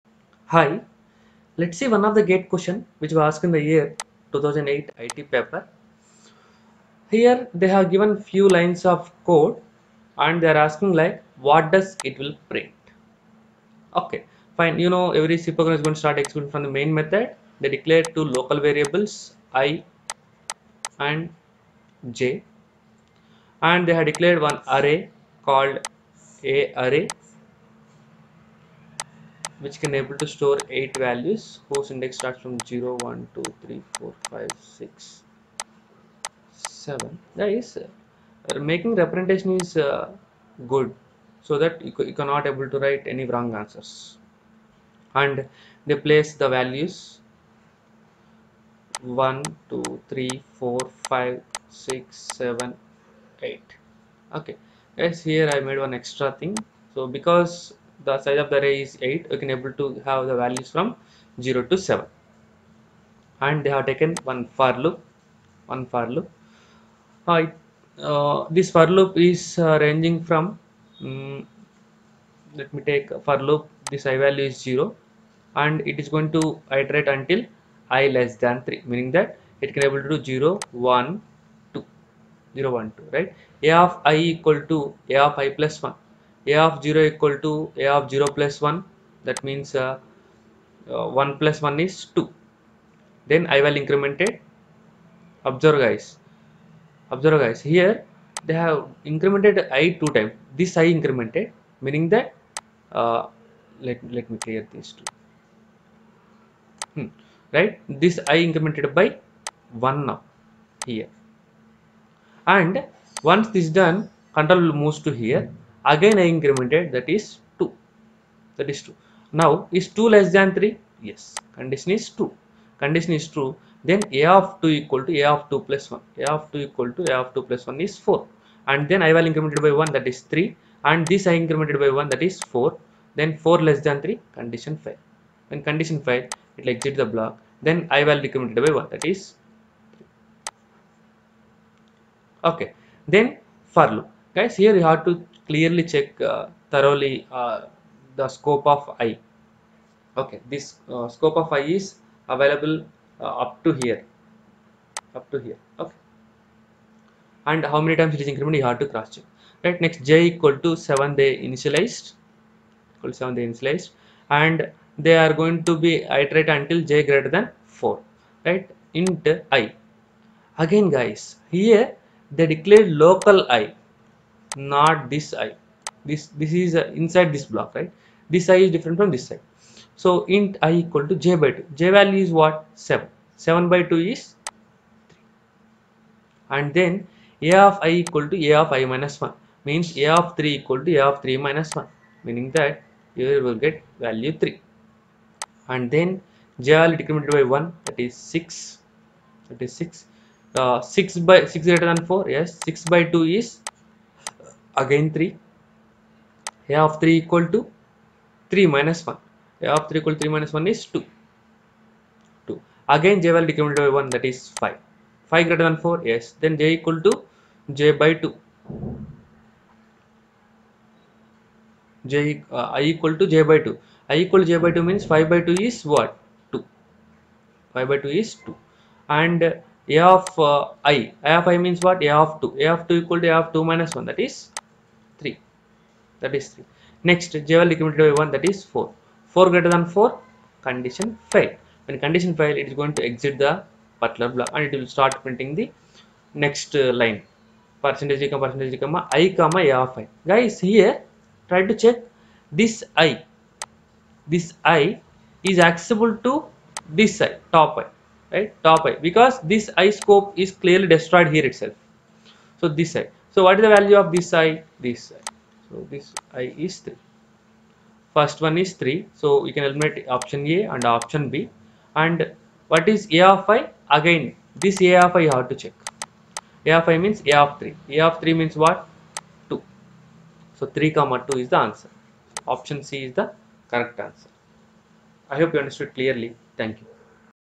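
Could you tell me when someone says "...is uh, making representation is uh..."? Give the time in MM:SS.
00:37.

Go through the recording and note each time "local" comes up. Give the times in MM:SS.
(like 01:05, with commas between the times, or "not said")
00:18, 02:53.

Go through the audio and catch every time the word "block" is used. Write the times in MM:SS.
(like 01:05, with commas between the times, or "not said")
02:17, 02:57, 04:04.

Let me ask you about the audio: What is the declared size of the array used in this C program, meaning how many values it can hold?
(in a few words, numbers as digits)
8.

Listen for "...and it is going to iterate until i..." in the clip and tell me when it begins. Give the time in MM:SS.
01:15.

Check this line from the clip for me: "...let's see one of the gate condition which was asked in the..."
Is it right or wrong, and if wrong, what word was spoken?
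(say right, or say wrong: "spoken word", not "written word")
wrong: "question", not "condition".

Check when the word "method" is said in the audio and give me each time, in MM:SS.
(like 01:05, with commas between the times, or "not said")
00:16.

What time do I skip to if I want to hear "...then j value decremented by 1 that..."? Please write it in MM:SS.
03:15.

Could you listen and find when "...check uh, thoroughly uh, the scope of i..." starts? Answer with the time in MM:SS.
02:25.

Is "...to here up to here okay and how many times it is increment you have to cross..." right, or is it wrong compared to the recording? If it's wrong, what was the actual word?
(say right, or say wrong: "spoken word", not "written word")
right.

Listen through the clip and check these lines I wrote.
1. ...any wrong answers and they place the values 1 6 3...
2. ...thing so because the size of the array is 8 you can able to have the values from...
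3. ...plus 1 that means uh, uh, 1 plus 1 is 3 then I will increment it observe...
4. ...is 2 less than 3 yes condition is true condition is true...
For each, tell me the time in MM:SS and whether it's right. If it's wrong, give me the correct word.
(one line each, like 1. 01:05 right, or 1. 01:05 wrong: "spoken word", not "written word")
1. 00:43 wrong: "2", not "6"
2. 00:56 right
3. 01:28 wrong: "2", not "3"
4. 01:59 right.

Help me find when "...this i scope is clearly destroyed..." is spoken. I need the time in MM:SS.
04:19.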